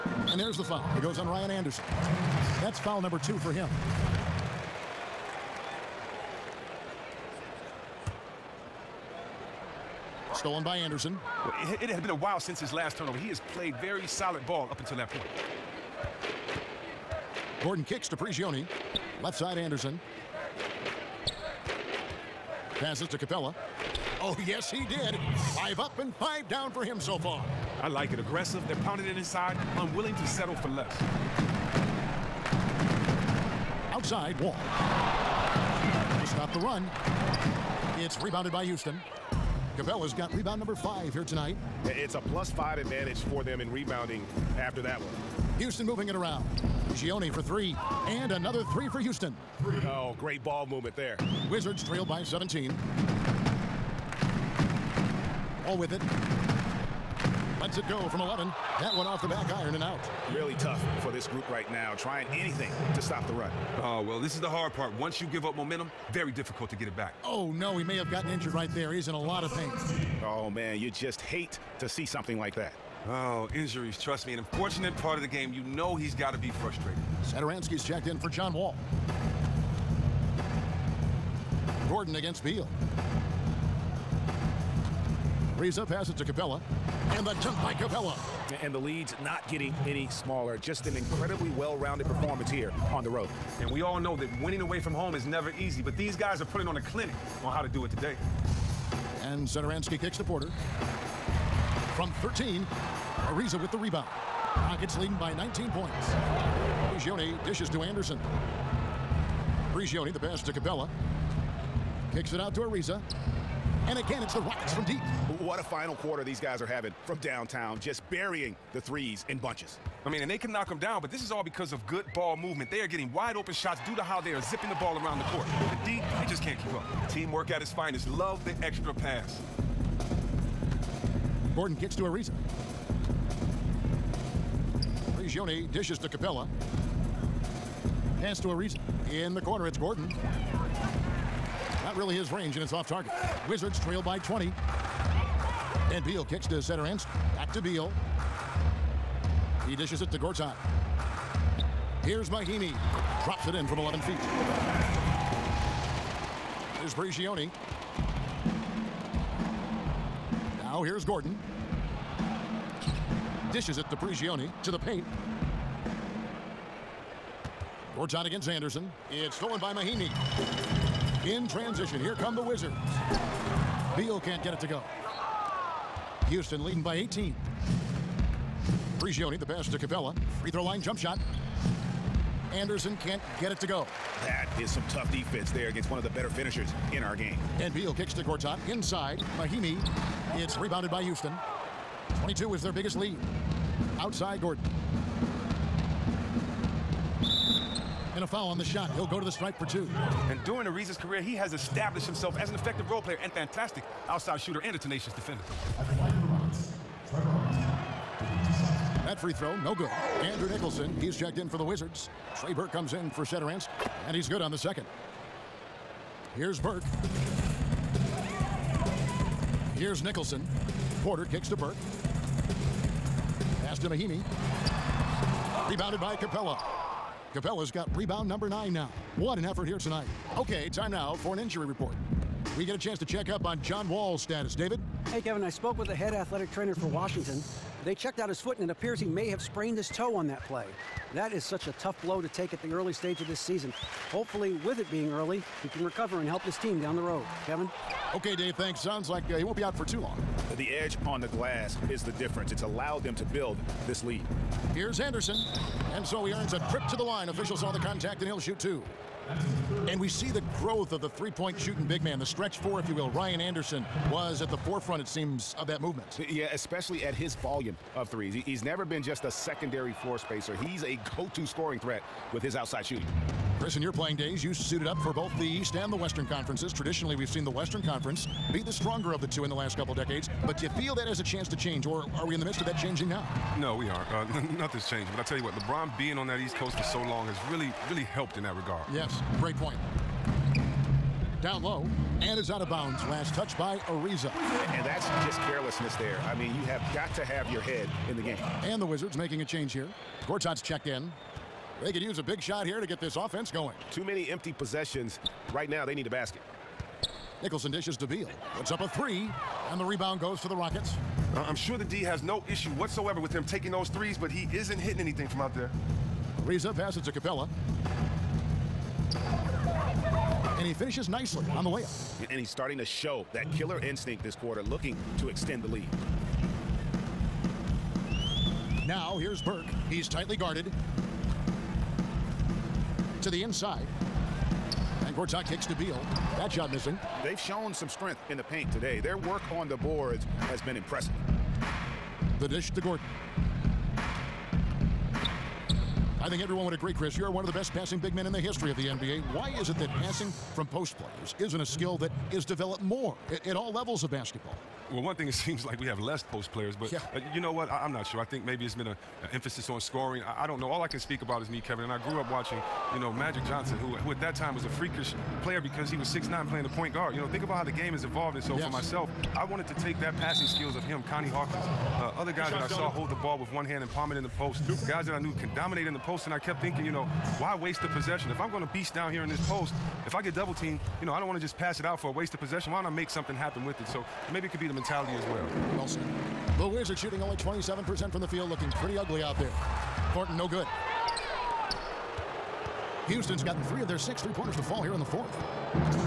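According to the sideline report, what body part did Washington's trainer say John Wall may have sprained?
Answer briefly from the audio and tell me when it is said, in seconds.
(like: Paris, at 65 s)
his toe, at 239 s.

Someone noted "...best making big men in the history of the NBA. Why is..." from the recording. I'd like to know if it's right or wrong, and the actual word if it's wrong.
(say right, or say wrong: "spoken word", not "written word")
wrong: "passing", not "making".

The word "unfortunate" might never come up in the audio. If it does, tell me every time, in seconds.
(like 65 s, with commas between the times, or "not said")
74 s.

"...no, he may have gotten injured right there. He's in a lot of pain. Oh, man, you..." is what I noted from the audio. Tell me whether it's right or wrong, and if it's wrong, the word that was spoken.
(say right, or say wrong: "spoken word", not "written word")
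right.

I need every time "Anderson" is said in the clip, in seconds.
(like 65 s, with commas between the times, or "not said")
1 s, 10 s, 19 s, 107 s, 168 s, 182 s, 254 s, 263 s.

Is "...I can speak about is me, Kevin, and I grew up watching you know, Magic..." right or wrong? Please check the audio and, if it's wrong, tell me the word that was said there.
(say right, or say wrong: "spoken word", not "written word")
right.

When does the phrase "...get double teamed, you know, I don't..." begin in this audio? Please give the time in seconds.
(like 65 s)
380 s.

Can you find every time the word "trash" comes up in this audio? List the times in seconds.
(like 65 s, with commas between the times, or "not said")
not said.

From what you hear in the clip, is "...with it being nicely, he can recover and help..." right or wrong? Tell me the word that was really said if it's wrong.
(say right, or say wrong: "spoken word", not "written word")
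wrong: "early", not "nicely".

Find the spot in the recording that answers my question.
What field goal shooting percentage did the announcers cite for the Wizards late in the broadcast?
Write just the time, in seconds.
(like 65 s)
387 s.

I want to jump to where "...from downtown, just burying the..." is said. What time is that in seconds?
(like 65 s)
117 s.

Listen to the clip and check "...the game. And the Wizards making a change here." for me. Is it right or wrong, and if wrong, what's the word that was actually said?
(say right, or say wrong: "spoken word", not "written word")
right.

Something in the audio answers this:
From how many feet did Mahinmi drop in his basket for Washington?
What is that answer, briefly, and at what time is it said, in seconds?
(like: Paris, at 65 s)
11, at 153 s.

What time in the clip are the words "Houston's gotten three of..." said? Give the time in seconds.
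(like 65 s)
393 s.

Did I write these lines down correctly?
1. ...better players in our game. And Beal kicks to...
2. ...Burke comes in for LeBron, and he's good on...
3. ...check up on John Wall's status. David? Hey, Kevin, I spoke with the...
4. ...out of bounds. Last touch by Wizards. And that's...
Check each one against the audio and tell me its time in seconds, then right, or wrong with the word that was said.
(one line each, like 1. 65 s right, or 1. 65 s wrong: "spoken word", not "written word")
1. 186 s wrong: "finishers", not "players"
2. 212 s wrong: "Satoransky", not "LeBron"
3. 233 s right
4. 292 s wrong: "Ariza", not "Wizards".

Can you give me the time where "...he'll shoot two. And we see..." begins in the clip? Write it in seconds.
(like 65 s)
258 s.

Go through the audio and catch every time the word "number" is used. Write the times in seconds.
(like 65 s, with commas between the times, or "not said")
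3 s, 40 s, 228 s.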